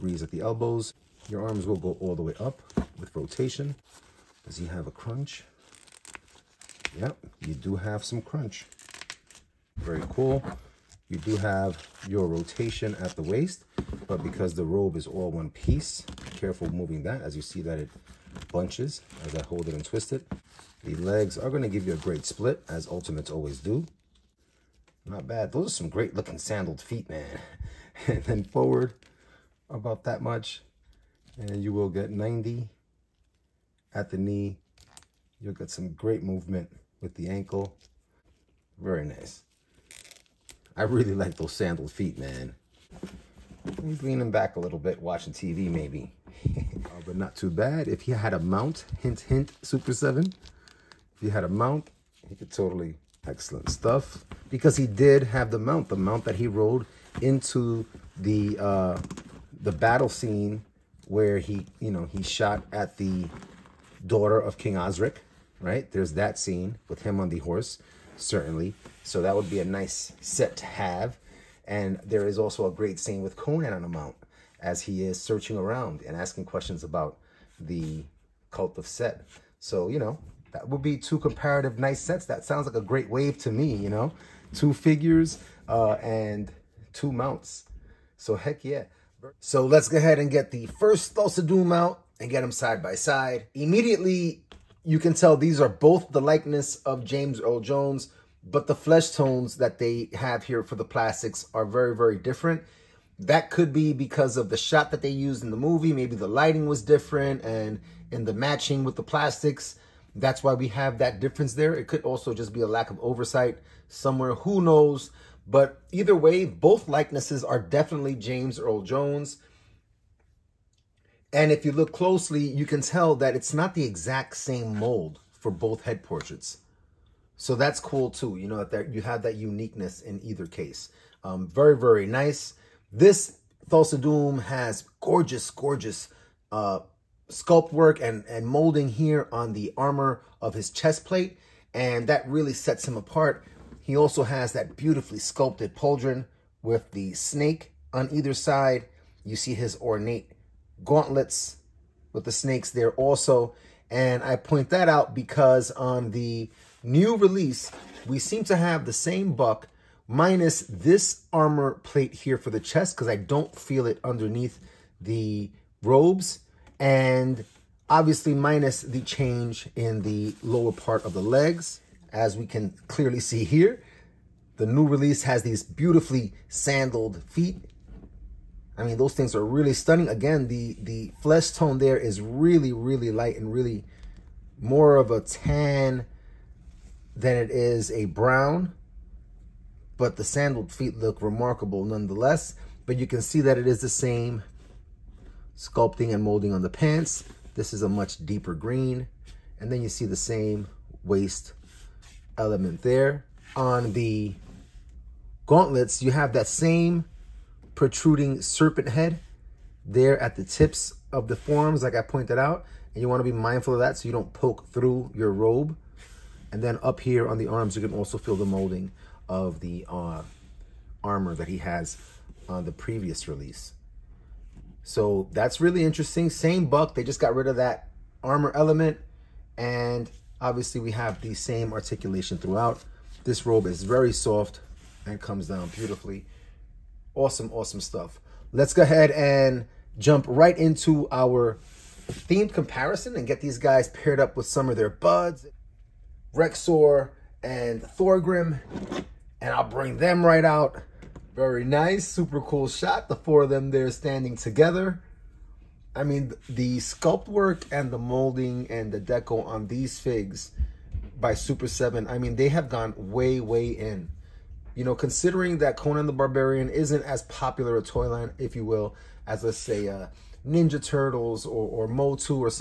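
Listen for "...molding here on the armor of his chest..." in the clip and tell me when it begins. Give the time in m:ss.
2:18.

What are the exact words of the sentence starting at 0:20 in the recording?
The legs are going to give you a great split, as Ultimates always do.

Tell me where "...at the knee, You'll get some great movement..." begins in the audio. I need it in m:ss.
0:33.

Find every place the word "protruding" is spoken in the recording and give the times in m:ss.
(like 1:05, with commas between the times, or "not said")
3:27.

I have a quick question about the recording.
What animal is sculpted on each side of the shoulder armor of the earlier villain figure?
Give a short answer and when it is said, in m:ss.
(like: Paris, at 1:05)
Snake, at 2:27.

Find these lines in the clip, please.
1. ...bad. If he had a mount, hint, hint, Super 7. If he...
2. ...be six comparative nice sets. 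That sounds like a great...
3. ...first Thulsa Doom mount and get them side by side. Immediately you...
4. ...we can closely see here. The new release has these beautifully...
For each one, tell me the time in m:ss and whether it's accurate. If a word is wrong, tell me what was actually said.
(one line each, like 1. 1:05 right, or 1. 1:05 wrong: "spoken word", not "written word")
1. 0:47 right
2. 1:20 wrong: "two", not "six"
3. 1:30 right
4. 2:52 wrong: "clearly", not "closely".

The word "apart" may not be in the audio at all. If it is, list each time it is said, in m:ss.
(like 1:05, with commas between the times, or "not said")
2:22.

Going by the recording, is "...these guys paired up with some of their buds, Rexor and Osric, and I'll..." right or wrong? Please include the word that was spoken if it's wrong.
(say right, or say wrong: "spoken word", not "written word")
wrong: "Thorgrim", not "Osric".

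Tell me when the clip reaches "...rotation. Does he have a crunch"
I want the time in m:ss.
0:03.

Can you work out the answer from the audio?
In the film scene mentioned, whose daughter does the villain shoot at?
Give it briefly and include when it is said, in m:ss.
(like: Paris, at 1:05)
King Osric, at 1:04.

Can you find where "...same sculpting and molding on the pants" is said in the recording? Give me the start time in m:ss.
3:13.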